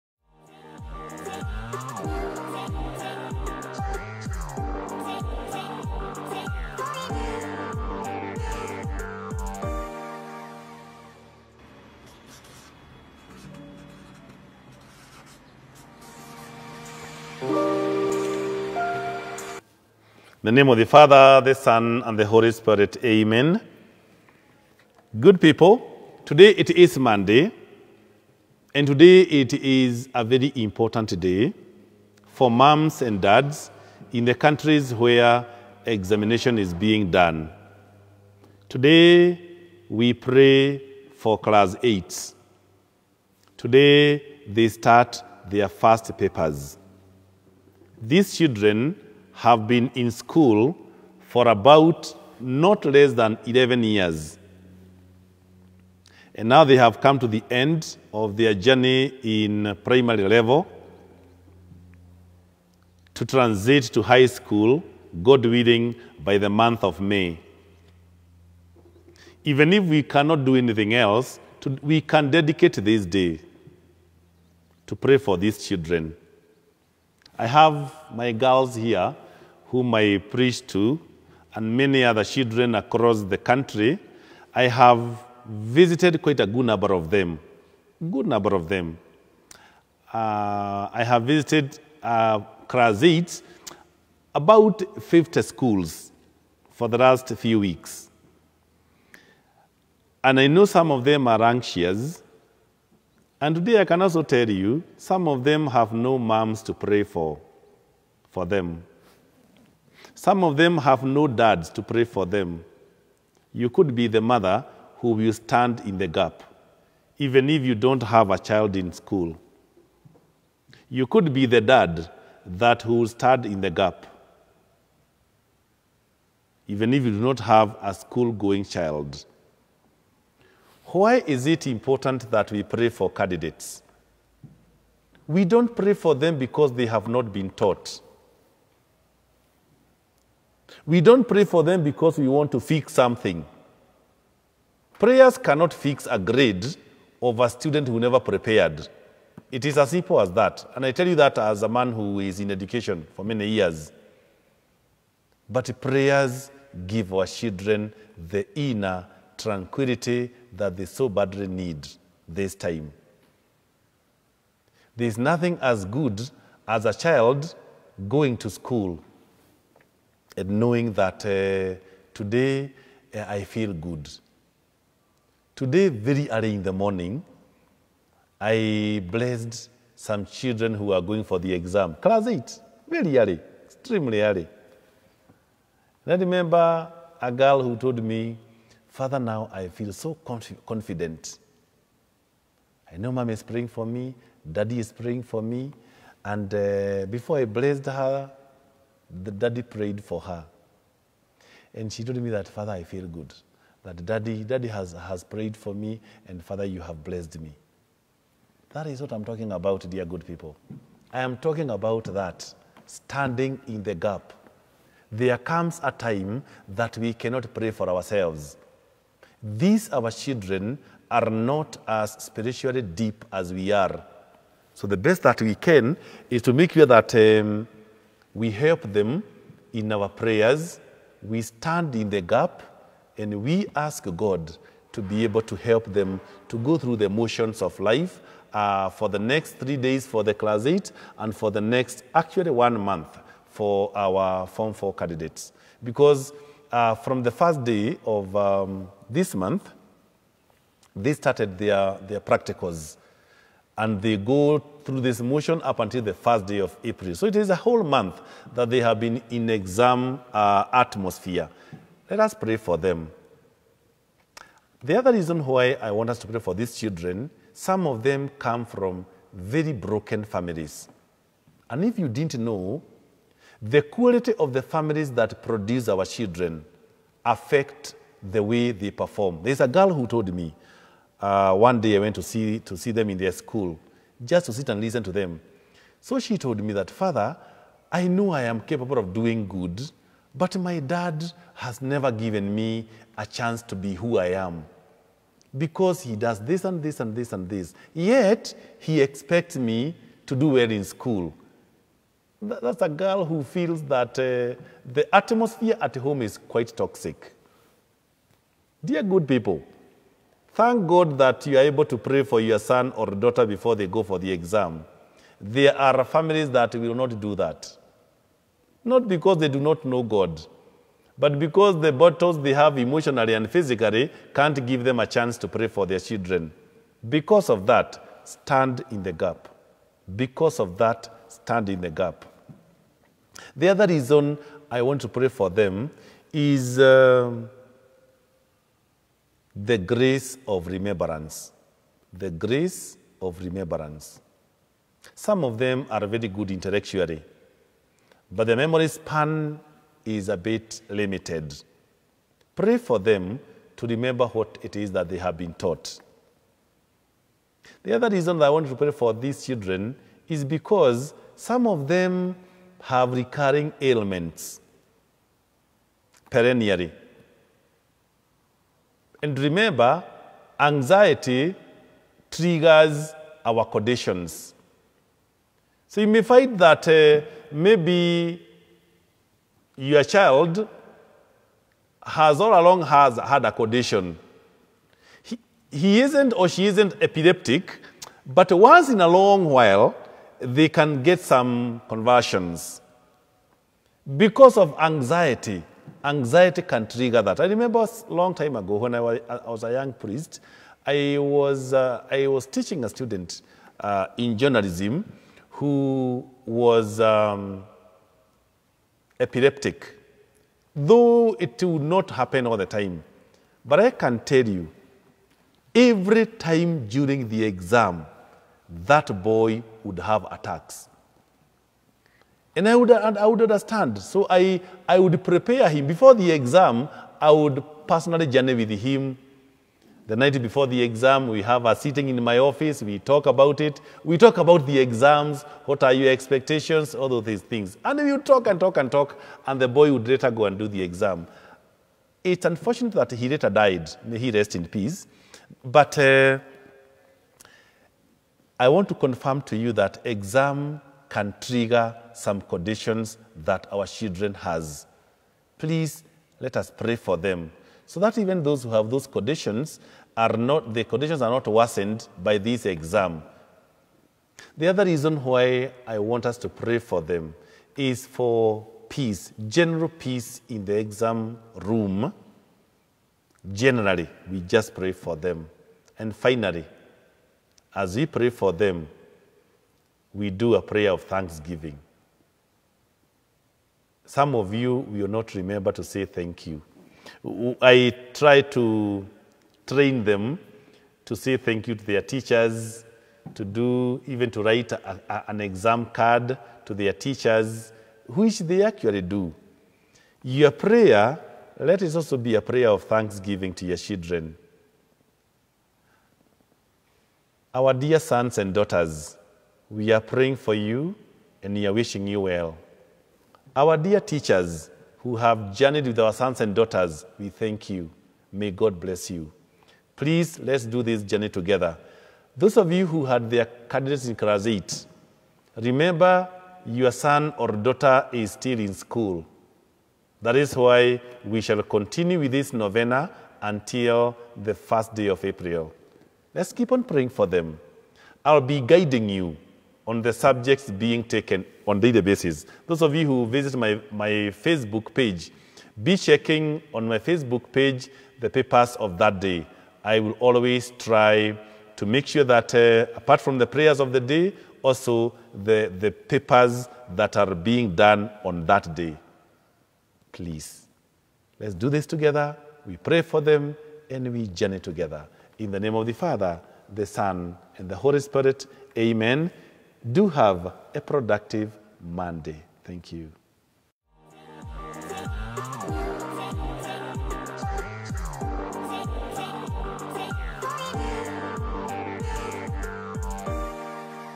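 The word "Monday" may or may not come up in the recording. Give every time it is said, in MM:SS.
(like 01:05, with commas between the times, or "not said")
00:26, 09:31.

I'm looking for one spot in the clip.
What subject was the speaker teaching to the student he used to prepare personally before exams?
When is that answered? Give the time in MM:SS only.
06:44.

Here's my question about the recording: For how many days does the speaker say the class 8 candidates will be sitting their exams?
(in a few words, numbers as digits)
3.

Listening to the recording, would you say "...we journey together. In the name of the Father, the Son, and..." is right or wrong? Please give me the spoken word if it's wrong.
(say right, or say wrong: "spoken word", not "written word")
right.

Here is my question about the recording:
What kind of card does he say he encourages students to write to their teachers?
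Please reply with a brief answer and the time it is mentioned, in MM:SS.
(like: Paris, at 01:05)
Exam card, at 08:15.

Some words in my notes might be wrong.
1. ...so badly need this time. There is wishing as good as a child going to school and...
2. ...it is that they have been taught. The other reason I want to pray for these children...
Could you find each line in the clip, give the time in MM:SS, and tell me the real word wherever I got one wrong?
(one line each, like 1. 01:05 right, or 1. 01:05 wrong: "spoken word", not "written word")
1. 02:40 wrong: "nothing", not "wishing"
2. 05:54 right.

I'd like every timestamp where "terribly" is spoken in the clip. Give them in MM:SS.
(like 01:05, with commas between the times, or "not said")
not said.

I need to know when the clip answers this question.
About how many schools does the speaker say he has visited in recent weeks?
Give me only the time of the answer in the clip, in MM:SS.
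01:34.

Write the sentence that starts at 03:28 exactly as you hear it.
That is what I'm talking about, dear good people.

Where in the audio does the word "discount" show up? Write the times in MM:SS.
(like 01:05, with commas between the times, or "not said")
not said.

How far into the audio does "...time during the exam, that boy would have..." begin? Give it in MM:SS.
06:56.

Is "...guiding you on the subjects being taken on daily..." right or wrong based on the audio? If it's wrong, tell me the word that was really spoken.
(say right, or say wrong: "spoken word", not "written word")
right.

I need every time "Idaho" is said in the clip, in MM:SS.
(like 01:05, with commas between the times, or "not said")
not said.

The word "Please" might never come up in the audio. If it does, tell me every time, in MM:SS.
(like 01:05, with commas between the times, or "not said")
07:35, 08:39, 09:20.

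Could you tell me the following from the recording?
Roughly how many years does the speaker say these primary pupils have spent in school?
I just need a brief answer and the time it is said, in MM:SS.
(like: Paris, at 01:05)
11, at 00:52.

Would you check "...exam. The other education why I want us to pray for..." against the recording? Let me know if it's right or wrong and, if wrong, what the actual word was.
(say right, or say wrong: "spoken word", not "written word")
wrong: "reason", not "education".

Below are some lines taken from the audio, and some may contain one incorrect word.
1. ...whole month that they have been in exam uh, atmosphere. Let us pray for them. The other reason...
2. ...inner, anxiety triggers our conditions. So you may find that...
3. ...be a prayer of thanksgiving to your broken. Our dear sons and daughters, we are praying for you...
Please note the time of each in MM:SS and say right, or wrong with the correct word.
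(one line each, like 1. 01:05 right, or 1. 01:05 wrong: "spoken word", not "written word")
1. 04:17 right
2. 06:09 wrong: "remember", not "inner"
3. 08:22 wrong: "children", not "broken".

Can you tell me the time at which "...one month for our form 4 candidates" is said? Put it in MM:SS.
04:02.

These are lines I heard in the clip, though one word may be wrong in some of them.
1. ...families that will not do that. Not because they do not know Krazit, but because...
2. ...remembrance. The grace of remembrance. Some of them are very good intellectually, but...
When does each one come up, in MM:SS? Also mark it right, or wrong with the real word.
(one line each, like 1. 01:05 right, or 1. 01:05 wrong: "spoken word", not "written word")
1. 05:16 wrong: "God", not "Krazit"
2. 05:40 right.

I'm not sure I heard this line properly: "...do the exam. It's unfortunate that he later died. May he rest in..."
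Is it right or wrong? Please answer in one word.
right.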